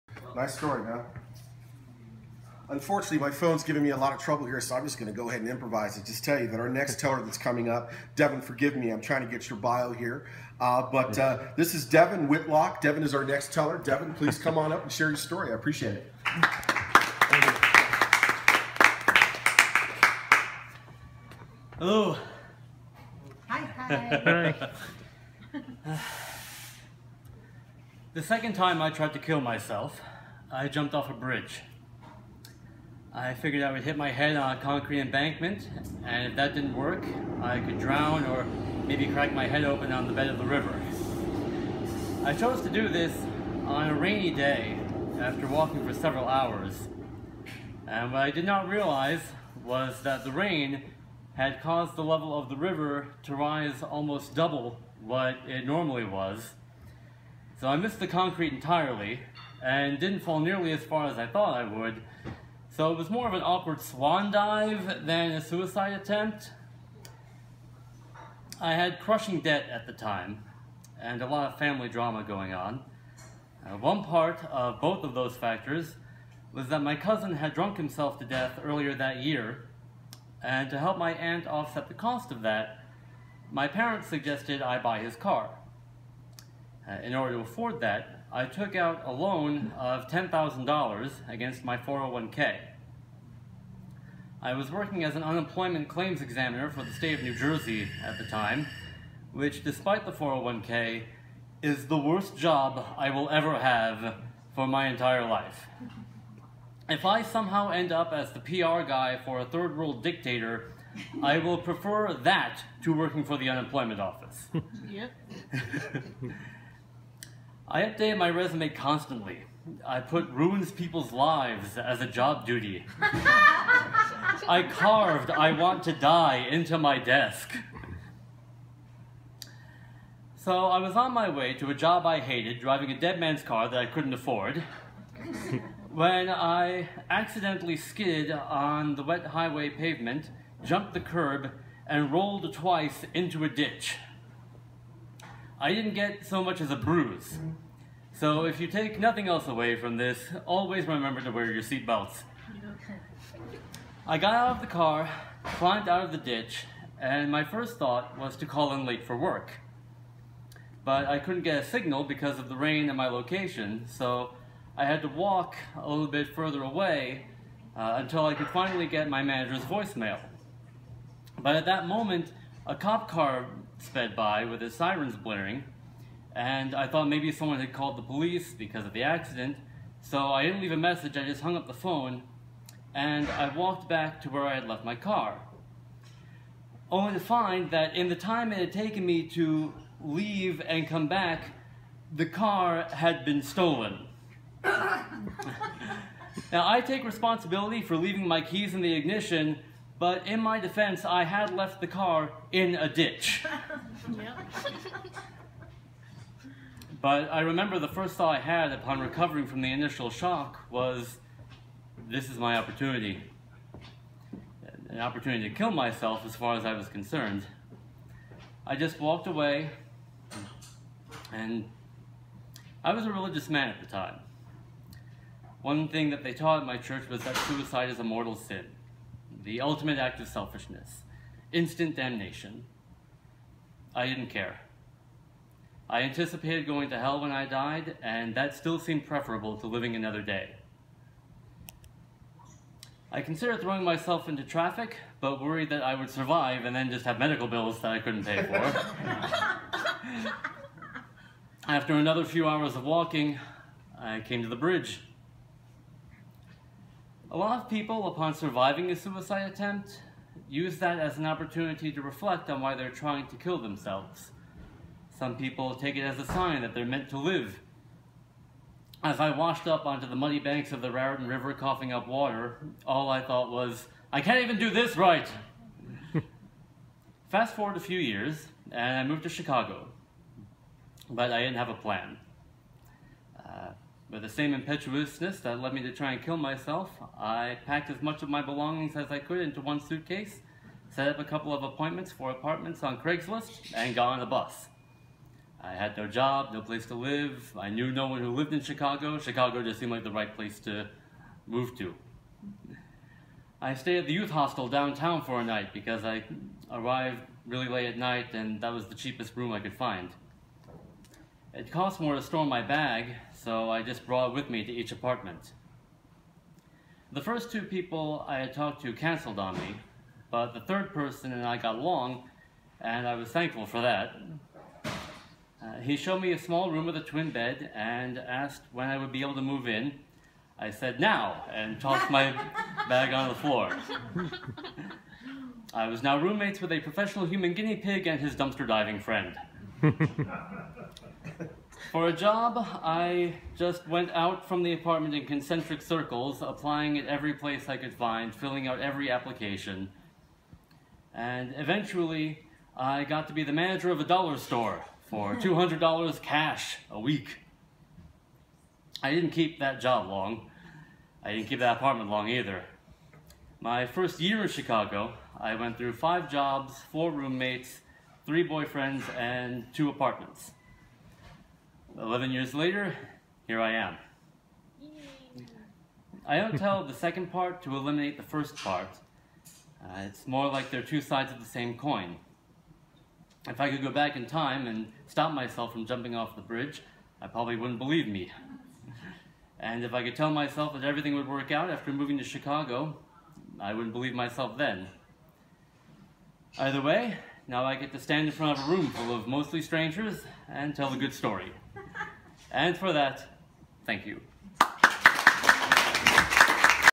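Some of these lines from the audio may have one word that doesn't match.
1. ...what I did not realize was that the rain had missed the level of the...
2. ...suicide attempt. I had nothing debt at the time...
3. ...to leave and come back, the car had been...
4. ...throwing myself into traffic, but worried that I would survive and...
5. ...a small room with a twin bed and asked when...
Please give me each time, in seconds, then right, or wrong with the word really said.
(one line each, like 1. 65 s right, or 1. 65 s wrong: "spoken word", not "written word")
1. 48 s wrong: "caused", not "missed"
2. 65 s wrong: "crushing", not "nothing"
3. 189 s right
4. 243 s right
5. 326 s right.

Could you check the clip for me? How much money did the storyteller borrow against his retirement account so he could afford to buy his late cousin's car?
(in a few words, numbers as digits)
$10,000.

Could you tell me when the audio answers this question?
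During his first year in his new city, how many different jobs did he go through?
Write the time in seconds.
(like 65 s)
365 s.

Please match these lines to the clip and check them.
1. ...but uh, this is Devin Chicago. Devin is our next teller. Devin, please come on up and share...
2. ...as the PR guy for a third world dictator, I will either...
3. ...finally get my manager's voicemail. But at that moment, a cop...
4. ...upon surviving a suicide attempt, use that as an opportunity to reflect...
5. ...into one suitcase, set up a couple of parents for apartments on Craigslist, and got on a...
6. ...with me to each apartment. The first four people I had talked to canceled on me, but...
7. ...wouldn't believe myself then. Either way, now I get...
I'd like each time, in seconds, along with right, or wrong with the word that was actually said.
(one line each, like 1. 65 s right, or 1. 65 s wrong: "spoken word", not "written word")
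1. 10 s wrong: "Whitlock", not "Chicago"
2. 108 s wrong: "prefer", not "either"
3. 168 s right
4. 258 s right
5. 289 s wrong: "appointments", not "parents"
6. 314 s wrong: "two", not "four"
7. 393 s right.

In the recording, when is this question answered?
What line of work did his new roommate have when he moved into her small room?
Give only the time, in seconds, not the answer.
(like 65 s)
336 s.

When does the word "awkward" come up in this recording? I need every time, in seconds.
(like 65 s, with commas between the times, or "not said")
63 s.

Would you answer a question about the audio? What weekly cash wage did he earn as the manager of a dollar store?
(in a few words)
$200.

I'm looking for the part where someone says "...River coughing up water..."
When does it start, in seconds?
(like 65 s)
271 s.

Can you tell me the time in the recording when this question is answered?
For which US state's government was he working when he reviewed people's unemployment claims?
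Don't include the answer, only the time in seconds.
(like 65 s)
97 s.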